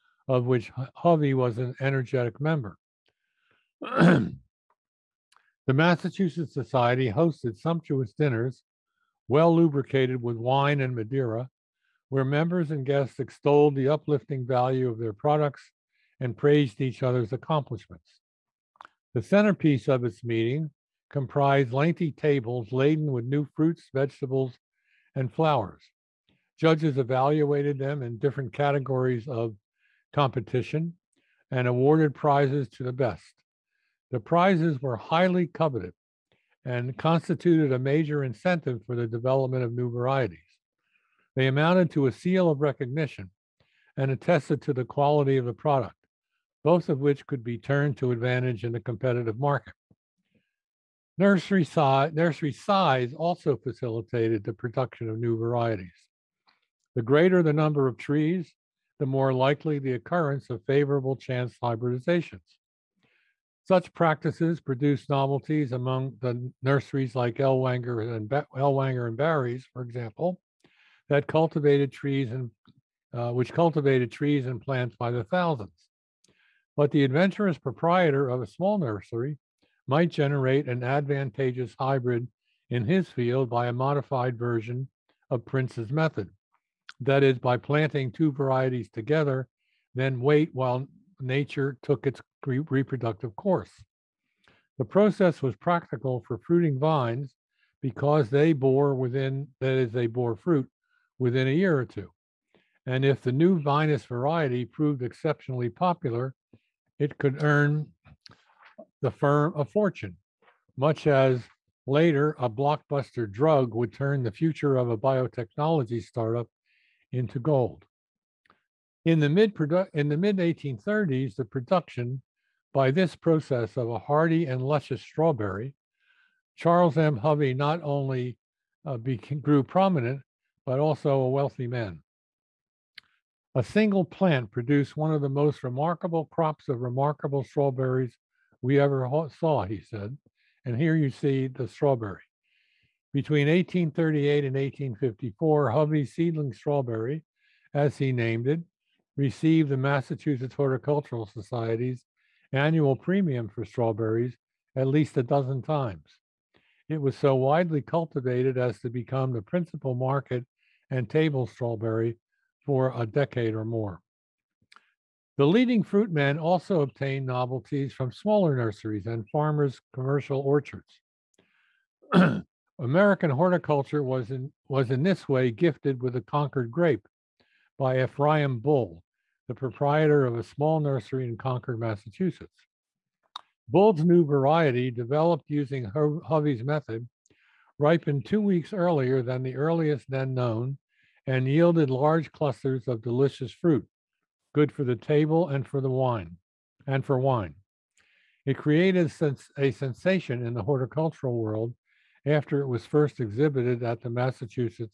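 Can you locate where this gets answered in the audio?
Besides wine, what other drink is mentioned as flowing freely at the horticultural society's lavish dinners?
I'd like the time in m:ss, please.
0:10.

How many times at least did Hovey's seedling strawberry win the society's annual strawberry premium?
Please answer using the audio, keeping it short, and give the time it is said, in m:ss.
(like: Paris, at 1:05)
12, at 2:35.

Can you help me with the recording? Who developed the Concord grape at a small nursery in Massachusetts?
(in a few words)
Ephraim Bull.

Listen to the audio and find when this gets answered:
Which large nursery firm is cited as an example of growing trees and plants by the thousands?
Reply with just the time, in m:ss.
1:08.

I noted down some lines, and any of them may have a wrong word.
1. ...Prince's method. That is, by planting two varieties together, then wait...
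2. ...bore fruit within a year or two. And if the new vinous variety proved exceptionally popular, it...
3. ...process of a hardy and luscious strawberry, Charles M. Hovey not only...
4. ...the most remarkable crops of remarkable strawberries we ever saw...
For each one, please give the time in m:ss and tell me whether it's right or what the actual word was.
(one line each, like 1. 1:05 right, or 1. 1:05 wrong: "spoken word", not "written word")
1. 1:25 right
2. 1:40 right
3. 2:03 right
4. 2:15 right.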